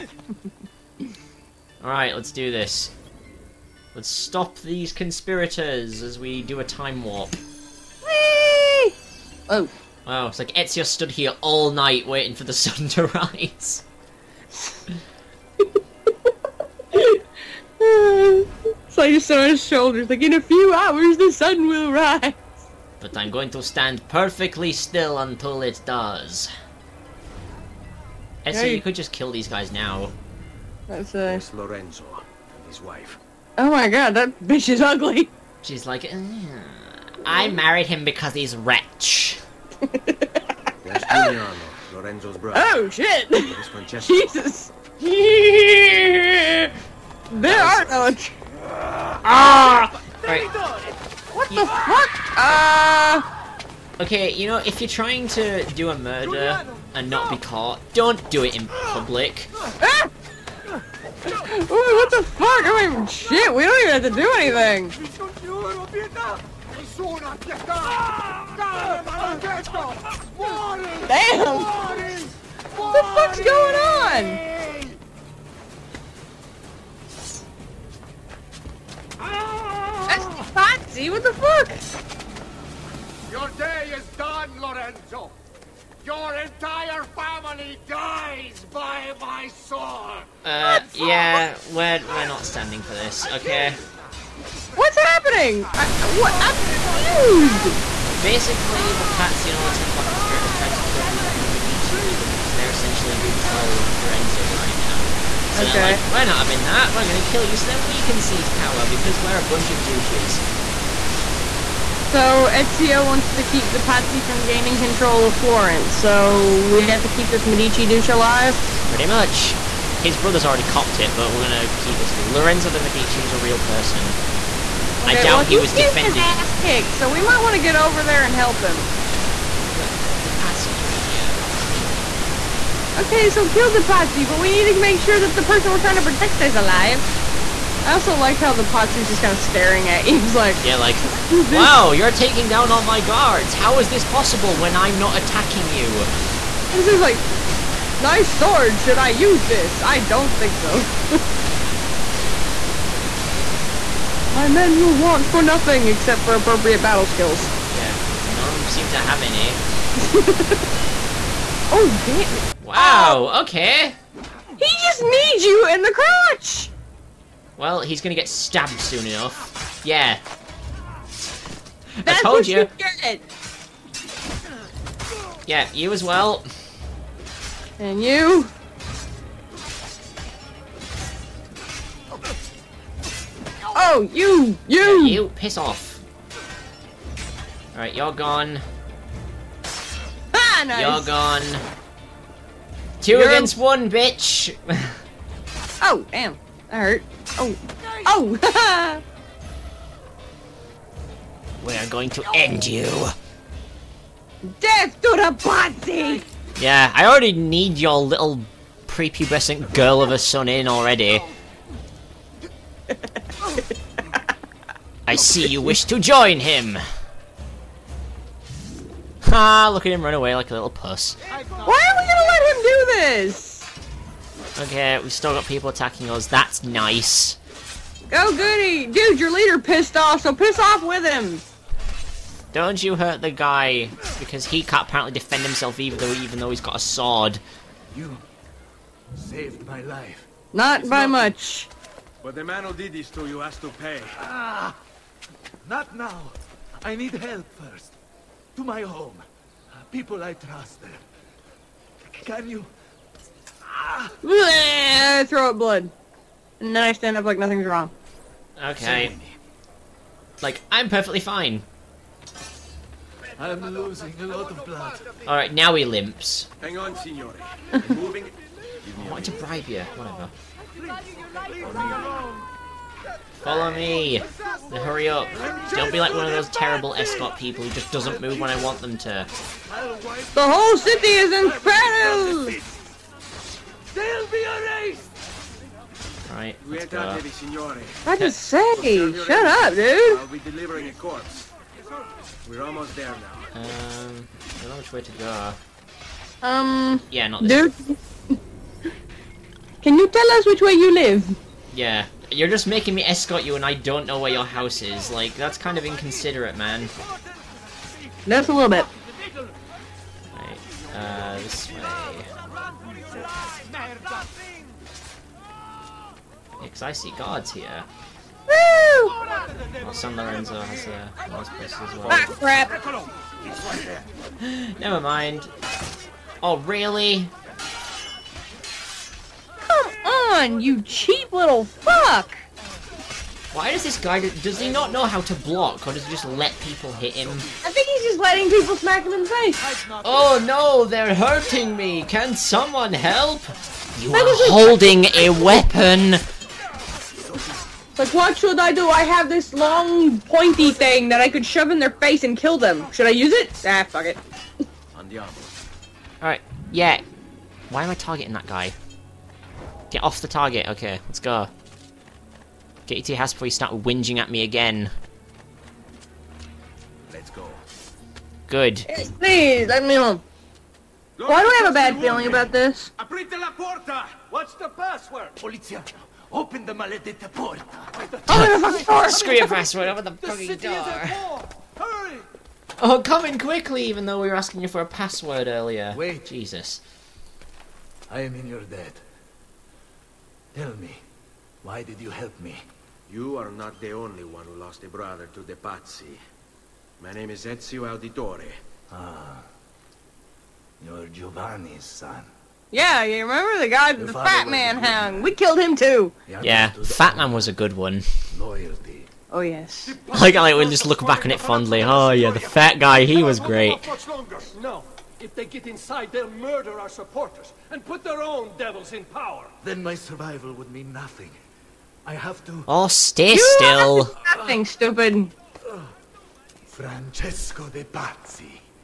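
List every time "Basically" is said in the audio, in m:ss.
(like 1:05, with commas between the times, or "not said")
1:38.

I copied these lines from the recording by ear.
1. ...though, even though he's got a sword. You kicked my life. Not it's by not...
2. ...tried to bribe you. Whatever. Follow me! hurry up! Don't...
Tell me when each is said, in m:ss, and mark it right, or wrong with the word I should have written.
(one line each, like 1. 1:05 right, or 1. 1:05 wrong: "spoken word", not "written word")
1. 3:55 wrong: "saved", not "kicked"
2. 4:29 wrong: "wanted", not "tried".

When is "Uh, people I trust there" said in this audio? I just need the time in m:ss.
4:09.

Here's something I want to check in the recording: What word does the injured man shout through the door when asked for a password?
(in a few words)
Polizia.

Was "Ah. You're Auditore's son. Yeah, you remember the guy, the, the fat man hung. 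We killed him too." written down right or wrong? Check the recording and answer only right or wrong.
wrong.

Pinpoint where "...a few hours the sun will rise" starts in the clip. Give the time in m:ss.
0:20.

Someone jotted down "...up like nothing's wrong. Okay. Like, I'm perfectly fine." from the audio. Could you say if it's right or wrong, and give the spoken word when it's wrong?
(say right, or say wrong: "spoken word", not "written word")
right.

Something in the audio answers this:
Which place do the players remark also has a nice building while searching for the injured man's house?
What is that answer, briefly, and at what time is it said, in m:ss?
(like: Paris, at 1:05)
San Lorenzo, at 5:19.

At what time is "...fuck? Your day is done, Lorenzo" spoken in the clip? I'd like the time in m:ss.
1:21.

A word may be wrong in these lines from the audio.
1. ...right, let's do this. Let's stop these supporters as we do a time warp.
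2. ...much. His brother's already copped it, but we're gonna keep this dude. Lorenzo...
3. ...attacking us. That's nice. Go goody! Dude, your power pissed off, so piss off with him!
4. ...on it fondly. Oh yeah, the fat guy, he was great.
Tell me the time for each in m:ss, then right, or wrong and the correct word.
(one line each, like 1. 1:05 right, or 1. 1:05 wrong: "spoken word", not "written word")
1. 0:01 wrong: "conspirators", not "supporters"
2. 1:59 right
3. 3:45 wrong: "leader", not "power"
4. 6:51 right.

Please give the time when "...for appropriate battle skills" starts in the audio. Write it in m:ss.
2:36.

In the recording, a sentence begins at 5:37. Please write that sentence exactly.
I think he's just letting people smack him in the face.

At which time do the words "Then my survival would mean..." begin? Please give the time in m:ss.
6:59.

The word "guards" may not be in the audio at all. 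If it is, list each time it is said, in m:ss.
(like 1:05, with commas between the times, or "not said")
2:23, 5:17.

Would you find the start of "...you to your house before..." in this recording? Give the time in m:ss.
6:02.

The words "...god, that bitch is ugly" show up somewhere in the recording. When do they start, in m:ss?
0:33.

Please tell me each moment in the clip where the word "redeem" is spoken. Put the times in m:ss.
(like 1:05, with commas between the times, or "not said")
not said.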